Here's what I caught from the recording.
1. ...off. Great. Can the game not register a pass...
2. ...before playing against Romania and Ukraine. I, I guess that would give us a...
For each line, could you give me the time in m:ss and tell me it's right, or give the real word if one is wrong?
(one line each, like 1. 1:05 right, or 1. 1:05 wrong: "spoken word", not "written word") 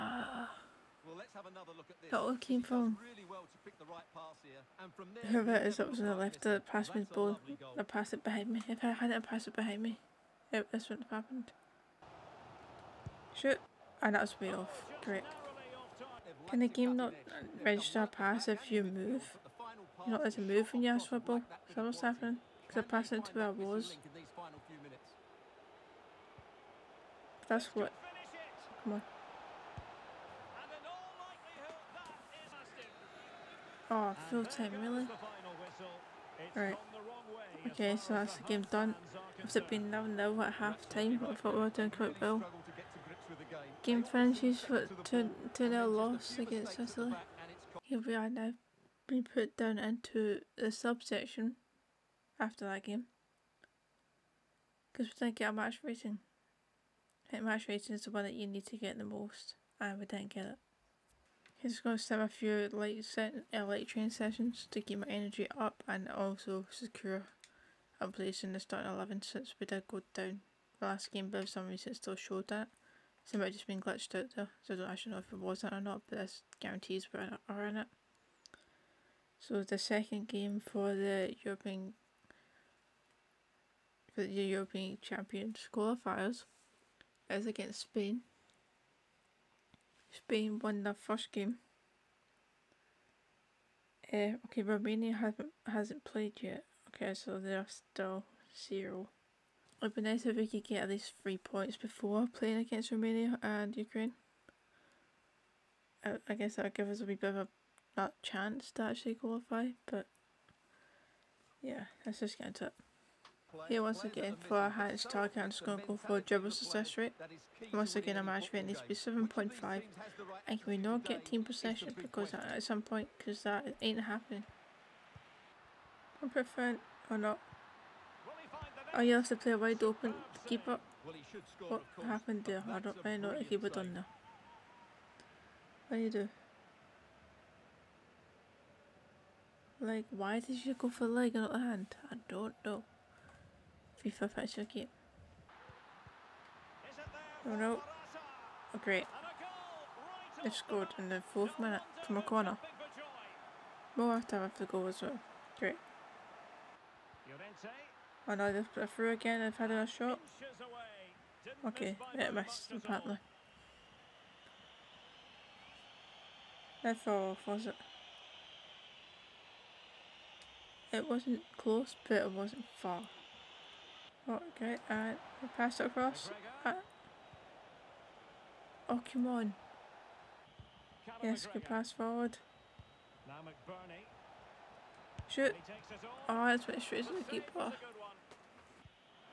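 1. 0:14 right
2. 1:41 right.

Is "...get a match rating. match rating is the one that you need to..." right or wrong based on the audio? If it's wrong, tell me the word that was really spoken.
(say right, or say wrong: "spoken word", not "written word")
right.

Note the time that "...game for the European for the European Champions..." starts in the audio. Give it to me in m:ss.
1:20.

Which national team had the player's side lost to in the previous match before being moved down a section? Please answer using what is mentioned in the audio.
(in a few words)
Sicily.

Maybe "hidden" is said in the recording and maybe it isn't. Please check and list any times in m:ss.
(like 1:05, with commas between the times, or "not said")
not said.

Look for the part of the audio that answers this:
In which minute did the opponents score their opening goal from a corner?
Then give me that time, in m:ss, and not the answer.
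2:31.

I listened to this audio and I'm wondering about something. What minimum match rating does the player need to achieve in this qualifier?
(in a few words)
7.5.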